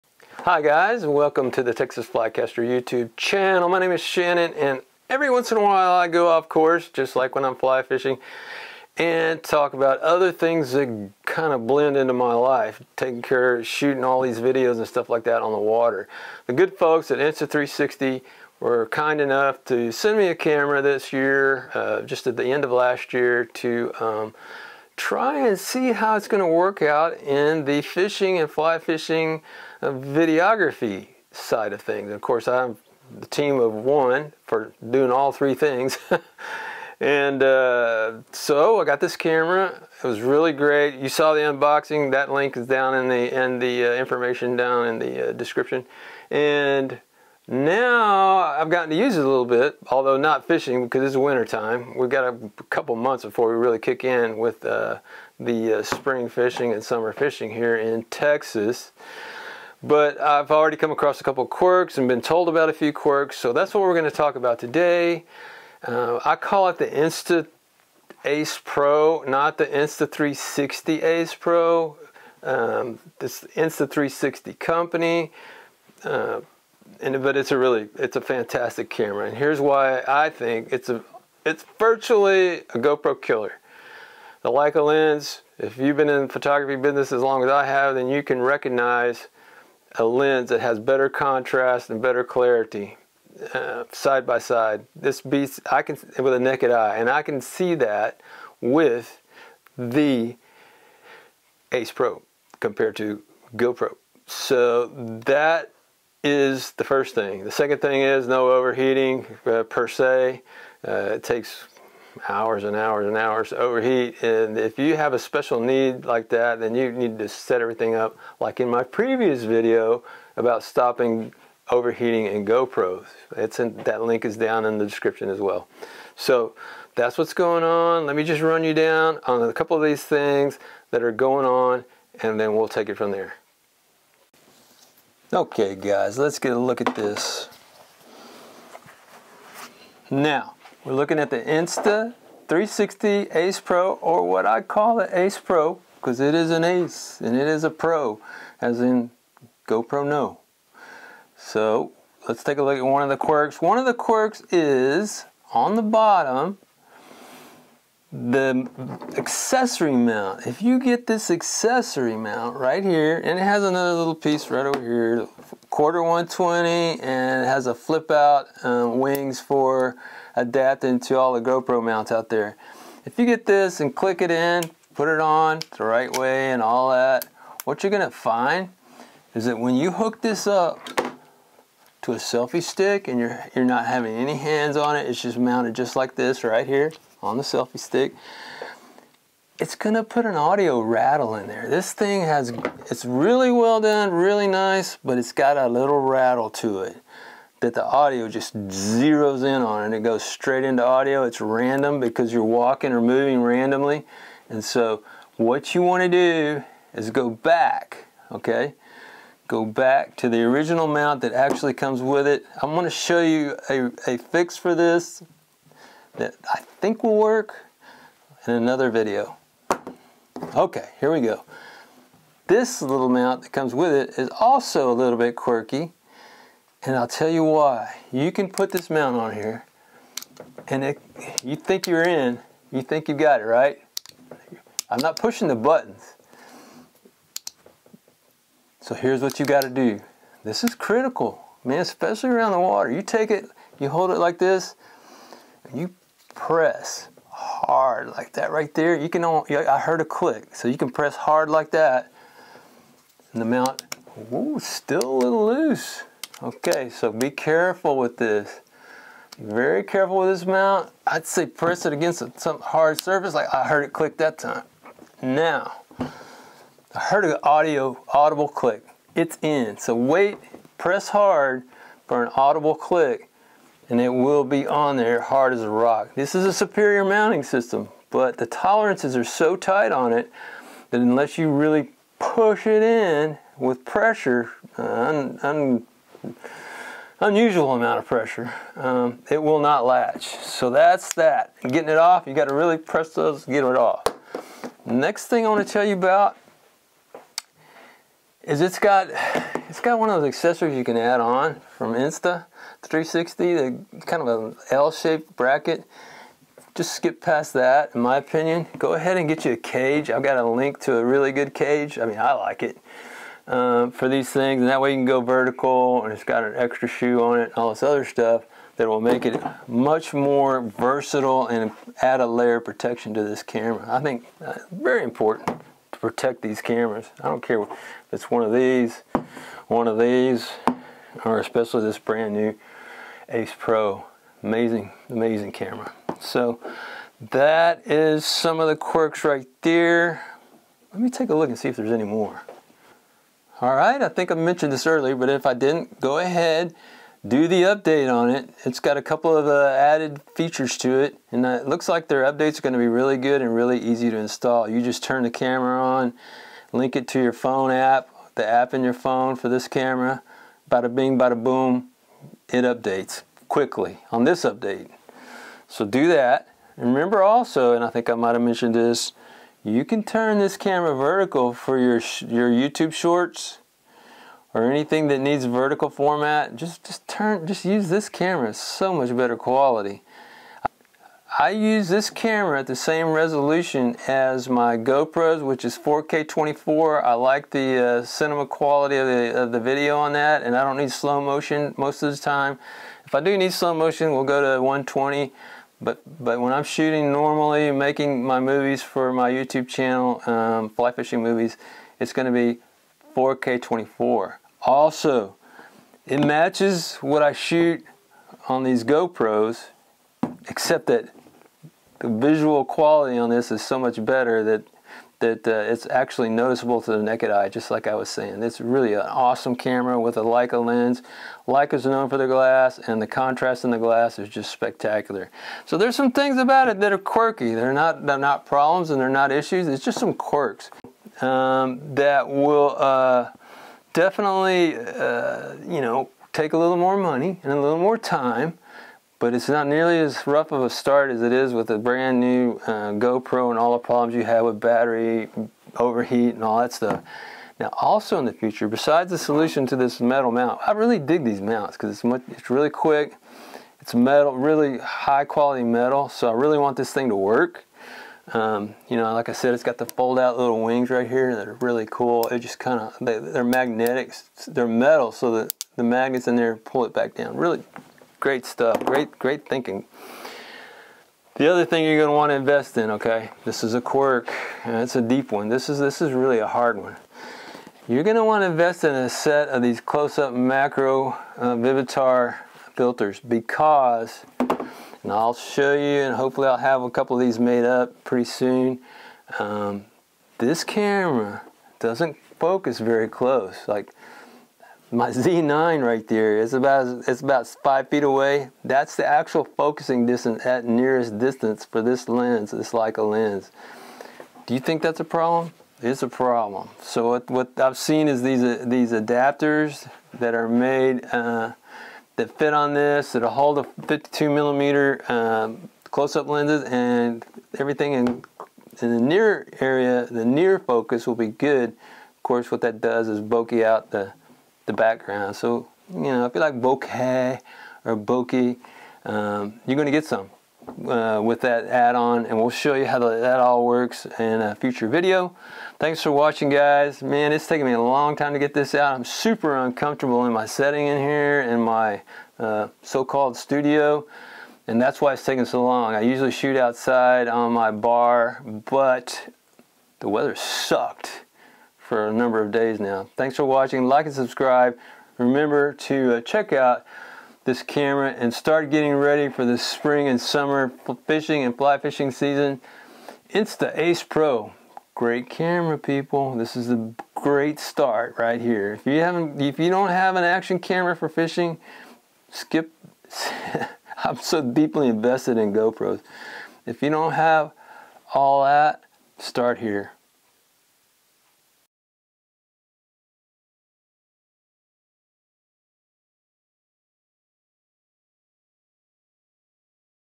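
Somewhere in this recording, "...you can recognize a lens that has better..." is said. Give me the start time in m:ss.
1:28.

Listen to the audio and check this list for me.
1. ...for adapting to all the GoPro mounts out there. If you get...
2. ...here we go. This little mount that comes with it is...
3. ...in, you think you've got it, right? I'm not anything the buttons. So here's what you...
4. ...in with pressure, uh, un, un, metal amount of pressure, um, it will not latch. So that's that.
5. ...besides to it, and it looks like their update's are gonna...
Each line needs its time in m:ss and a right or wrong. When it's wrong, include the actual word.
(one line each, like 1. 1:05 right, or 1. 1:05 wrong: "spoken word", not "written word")
1. 2:49 right
2. 3:40 right
3. 3:52 wrong: "pushing", not "anything"
4. 4:42 wrong: "unusual", not "metal"
5. 5:50 wrong: "features", not "besides".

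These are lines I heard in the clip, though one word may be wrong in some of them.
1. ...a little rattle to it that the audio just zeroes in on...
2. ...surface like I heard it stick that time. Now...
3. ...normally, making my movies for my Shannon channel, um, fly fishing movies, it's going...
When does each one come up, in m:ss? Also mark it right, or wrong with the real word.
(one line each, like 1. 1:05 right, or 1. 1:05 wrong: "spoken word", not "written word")
1. 3:15 right
2. 4:23 wrong: "click", not "stick"
3. 6:37 wrong: "YouTube", not "Shannon".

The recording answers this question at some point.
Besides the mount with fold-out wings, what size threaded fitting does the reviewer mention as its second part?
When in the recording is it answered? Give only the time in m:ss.
2:45.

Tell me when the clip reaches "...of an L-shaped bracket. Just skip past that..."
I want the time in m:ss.
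5:04.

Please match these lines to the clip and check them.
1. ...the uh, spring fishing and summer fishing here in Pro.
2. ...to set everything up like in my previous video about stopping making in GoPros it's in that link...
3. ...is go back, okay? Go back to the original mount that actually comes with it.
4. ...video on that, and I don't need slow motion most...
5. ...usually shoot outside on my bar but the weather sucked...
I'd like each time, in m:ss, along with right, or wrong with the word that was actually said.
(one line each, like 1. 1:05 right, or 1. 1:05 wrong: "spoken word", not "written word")
1. 0:55 wrong: "Texas", not "Pro"
2. 1:57 wrong: "overheating", not "making"
3. 3:26 right
4. 6:29 right
5. 9:06 right.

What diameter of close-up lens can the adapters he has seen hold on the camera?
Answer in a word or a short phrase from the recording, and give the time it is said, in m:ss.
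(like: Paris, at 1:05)
52 millimeter, at 8:33.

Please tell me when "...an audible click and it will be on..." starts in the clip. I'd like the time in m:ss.
4:32.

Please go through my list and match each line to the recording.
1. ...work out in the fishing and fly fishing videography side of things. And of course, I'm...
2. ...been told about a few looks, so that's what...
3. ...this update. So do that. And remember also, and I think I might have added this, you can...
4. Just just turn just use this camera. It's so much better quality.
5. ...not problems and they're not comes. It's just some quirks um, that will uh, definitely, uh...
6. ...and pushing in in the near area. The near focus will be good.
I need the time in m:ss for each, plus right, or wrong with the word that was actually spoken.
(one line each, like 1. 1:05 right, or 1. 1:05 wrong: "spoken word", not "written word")
1. 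0:26 right
2. 1:02 wrong: "quirks", not "looks"
3. 6:04 wrong: "mentioned", not "added"
4. 6:16 right
5. 7:08 wrong: "issues", not "comes"
6. 8:36 wrong: "everything", not "pushing".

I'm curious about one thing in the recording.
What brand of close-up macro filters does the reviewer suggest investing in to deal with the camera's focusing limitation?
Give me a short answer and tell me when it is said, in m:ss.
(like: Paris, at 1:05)
Vivitar, at 8:01.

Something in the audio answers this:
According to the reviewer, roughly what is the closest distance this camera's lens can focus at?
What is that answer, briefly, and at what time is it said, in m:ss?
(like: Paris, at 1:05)
5 feet, at 8:17.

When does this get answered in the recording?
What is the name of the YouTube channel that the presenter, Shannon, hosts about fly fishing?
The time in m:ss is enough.
0:01.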